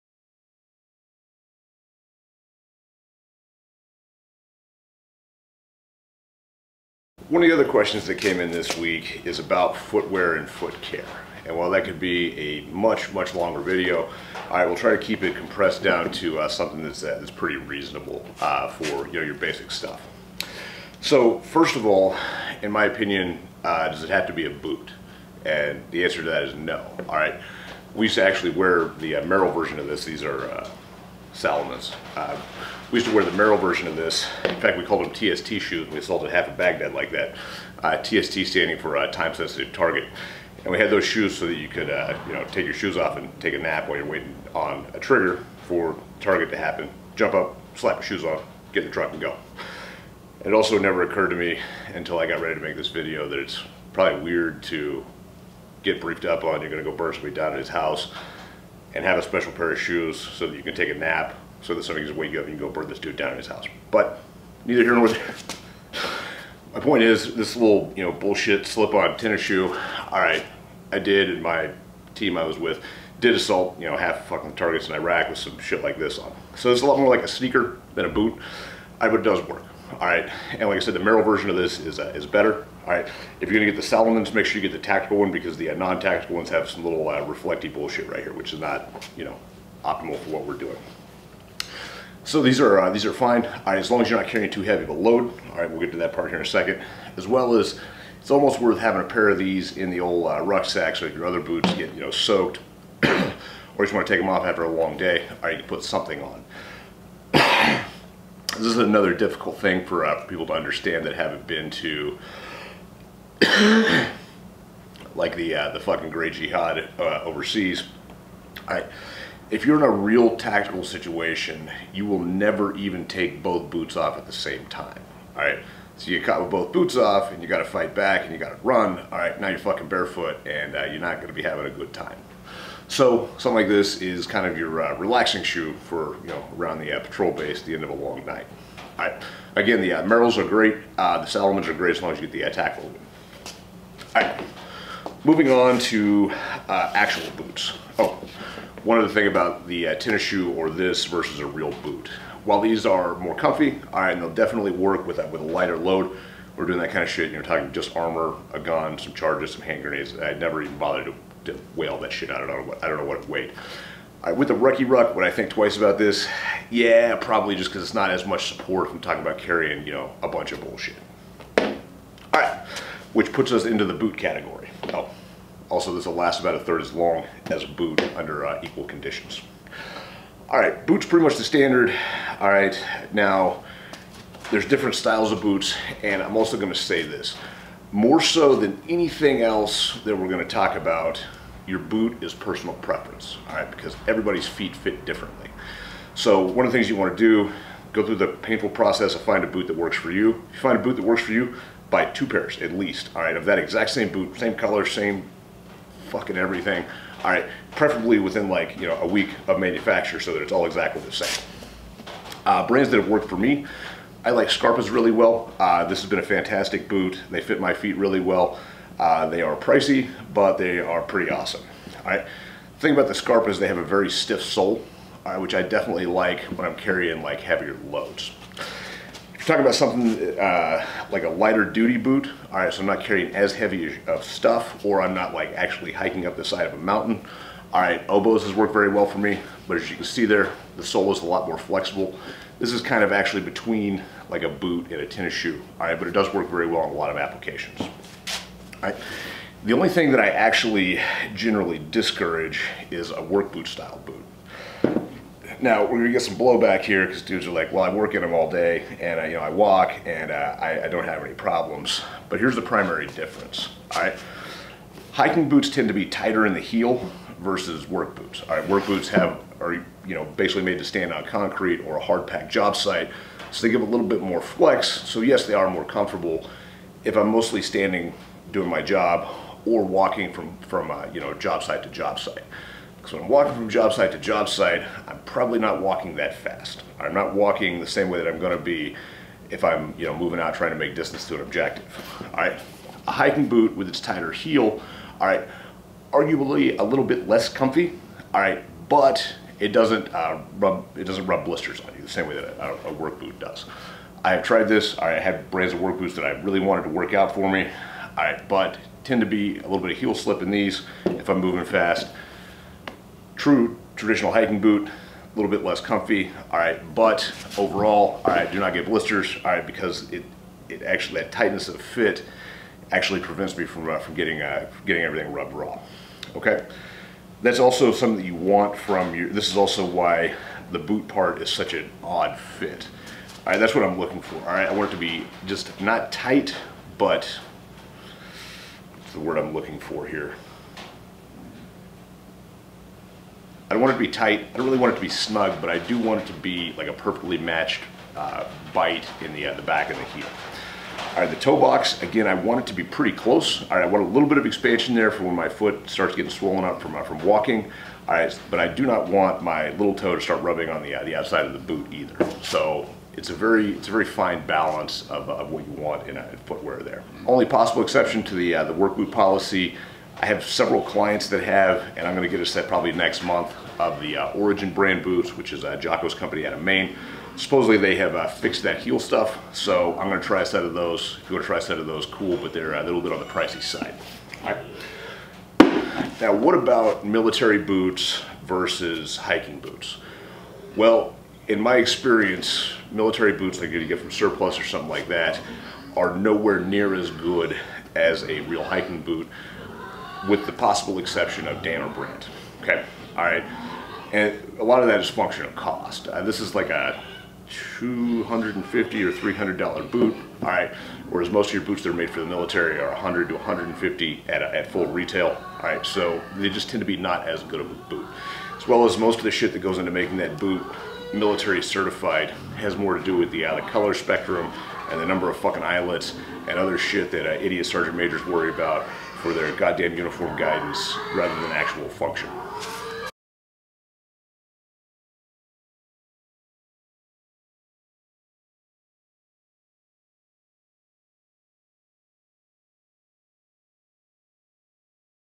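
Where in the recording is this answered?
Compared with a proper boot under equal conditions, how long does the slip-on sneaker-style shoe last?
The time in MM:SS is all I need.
02:56.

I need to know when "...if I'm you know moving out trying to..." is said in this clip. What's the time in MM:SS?
04:49.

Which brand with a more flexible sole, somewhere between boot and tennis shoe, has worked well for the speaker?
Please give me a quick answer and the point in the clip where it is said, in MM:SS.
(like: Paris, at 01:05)
Oboz, at 03:58.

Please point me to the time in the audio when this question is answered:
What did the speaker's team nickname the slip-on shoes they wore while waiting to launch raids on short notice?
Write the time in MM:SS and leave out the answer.
00:35.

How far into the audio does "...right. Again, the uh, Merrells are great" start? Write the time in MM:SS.
02:19.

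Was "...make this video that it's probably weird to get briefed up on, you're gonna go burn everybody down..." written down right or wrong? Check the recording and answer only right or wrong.
wrong.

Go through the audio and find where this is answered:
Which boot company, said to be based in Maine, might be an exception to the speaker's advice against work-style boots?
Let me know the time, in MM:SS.
06:14.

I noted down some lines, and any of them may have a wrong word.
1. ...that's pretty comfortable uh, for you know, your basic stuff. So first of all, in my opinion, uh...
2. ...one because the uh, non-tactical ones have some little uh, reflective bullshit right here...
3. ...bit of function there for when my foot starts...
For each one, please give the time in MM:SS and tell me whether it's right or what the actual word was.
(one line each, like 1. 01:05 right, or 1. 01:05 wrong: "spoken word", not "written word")
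1. 00:17 wrong: "reasonable", not "comfortable"
2. 01:25 right
3. 05:54 wrong: "expansion", not "function".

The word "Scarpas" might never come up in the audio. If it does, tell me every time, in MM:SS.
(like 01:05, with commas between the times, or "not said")
03:34, 03:43.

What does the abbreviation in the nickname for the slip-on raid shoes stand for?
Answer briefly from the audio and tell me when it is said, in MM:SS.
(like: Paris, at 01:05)
time-sensitive target, at 00:39.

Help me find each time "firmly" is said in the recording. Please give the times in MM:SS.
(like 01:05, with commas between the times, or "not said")
not said.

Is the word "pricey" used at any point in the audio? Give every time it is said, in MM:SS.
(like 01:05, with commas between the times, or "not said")
03:39, 06:23.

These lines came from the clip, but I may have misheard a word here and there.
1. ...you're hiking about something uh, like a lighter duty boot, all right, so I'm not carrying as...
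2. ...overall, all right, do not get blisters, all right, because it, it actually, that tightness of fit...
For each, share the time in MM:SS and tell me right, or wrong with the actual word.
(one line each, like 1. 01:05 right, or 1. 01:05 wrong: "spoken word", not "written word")
1. 03:49 wrong: "talking", not "hiking"
2. 05:17 right.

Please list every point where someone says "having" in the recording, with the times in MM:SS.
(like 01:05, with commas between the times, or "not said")
01:38, 02:11.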